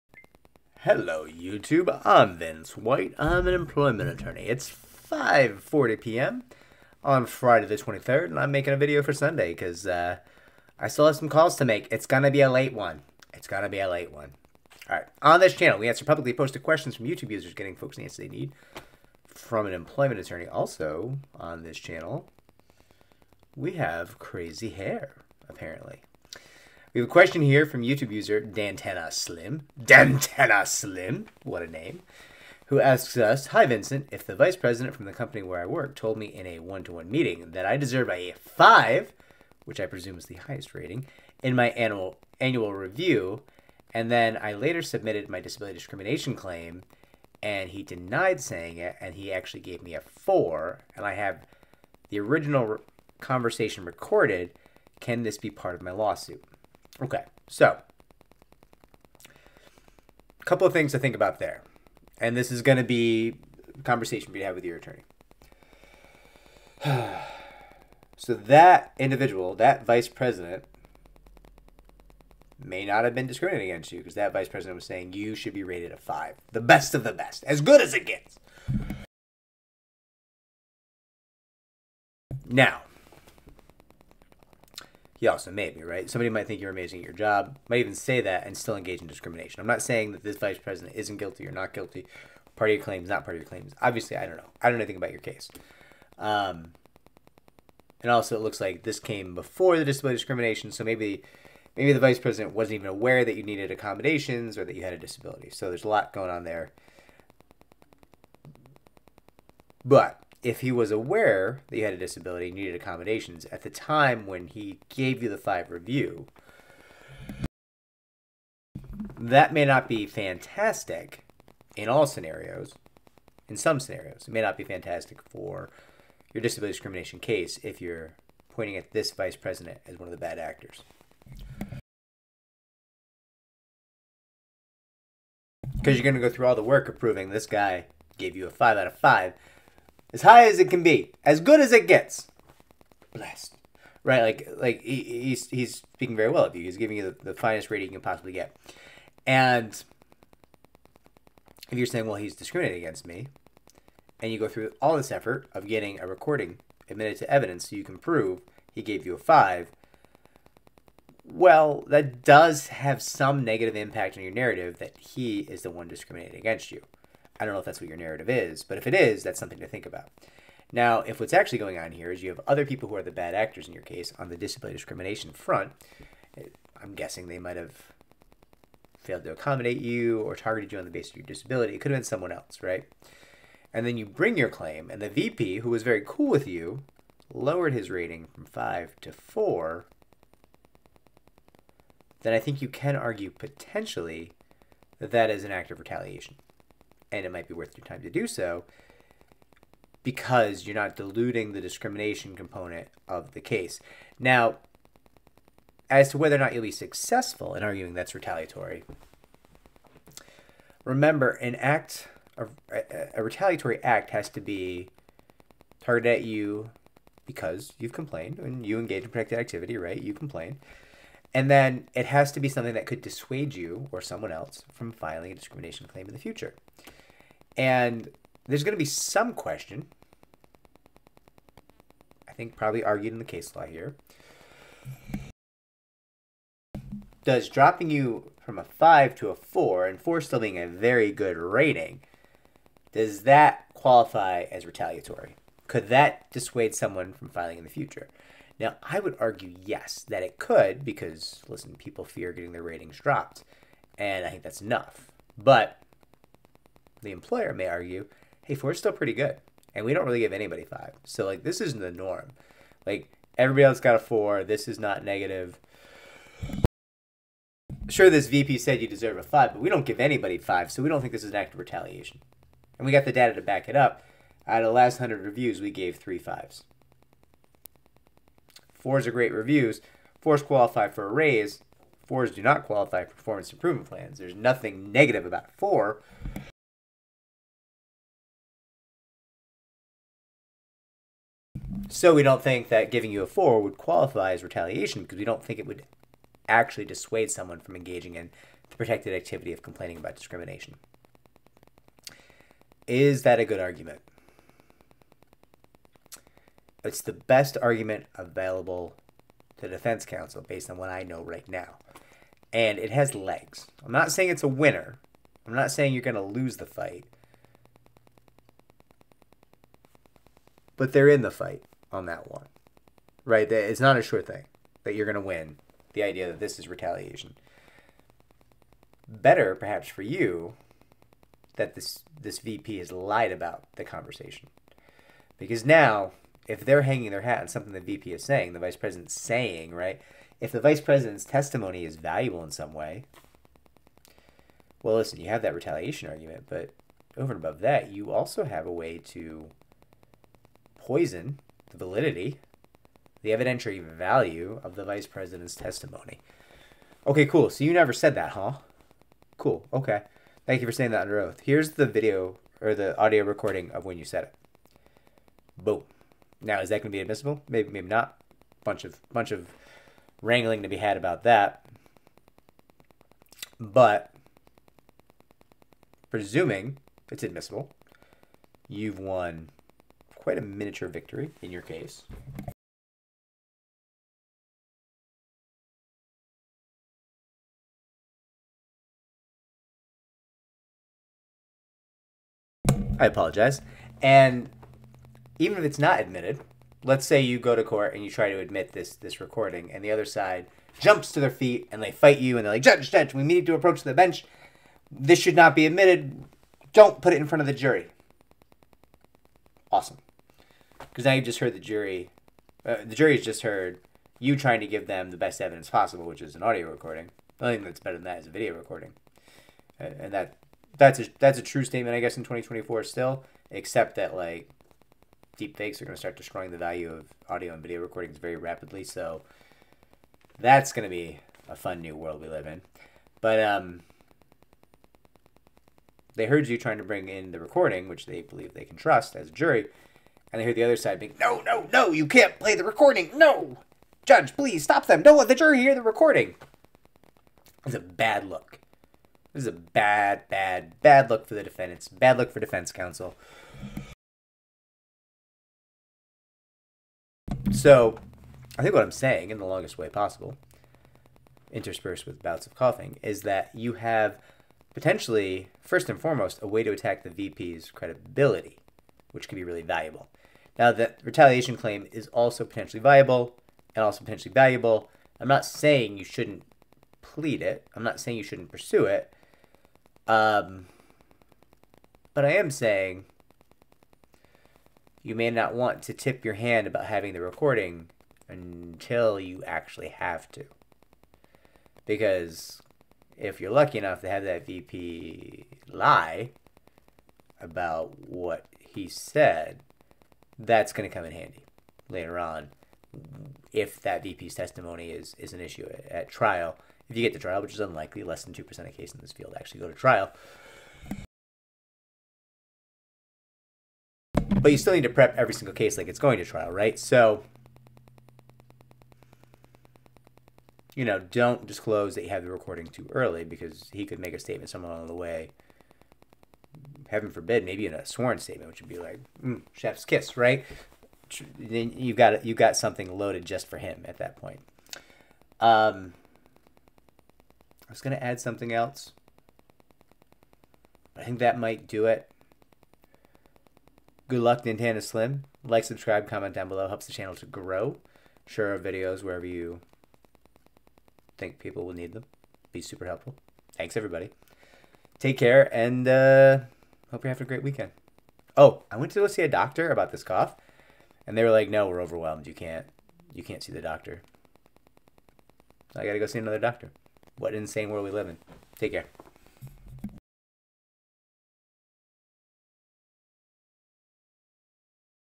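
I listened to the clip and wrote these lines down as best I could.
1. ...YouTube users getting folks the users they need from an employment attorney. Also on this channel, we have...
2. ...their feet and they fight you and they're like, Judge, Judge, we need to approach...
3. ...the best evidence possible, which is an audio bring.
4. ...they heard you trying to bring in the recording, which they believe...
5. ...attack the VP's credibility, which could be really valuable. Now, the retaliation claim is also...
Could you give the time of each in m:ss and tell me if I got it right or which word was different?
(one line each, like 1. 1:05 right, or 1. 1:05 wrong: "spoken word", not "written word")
1. 0:17 wrong: "answers", not "users"
2. 6:41 right
3. 6:55 wrong: "recording", not "bring"
4. 7:16 right
5. 7:46 right.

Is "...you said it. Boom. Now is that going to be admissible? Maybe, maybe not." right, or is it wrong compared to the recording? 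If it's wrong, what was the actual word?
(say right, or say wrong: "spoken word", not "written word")
right.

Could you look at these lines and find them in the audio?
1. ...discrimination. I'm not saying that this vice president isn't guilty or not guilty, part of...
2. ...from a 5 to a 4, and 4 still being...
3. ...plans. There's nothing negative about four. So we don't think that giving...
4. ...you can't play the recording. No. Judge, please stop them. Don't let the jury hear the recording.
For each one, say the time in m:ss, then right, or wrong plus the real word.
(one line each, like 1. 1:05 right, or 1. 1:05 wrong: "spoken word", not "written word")
1. 1:29 right
2. 3:58 right
3. 4:43 right
4. 7:21 right.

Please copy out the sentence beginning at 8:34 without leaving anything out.
But you still need to prep every single case like it's going to trial, right?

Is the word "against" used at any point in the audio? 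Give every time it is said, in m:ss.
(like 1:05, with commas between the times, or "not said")
1:13, 2:32, 2:46.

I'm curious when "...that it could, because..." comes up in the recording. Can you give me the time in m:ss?
4:10.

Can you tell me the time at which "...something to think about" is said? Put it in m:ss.
2:49.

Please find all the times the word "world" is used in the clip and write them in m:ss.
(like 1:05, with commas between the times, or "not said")
7:11, 9:27.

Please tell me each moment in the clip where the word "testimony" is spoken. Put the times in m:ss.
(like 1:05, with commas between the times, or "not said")
5:41, 5:55, 8:24.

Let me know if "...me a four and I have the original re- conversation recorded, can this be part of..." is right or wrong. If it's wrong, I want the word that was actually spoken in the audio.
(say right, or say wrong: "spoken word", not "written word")
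right.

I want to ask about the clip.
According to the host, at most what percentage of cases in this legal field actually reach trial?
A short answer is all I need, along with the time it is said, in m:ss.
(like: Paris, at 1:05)
2%, at 8:28.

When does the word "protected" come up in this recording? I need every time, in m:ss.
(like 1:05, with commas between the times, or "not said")
3:39, 4:58.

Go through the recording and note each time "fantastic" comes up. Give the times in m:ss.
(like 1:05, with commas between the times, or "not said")
2:00, 2:04.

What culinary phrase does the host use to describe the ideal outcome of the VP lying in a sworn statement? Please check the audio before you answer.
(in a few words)
chef's kiss.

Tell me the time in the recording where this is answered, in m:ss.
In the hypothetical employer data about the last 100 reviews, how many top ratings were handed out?
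4:35.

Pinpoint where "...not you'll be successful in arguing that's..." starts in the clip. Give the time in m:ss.
3:26.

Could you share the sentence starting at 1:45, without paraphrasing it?
So there's a lot going on there.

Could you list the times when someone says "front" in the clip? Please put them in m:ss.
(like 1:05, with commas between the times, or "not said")
2:55, 6:47.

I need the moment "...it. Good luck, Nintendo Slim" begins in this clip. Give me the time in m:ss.
9:01.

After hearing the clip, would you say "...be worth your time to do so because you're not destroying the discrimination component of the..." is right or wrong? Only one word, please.
wrong.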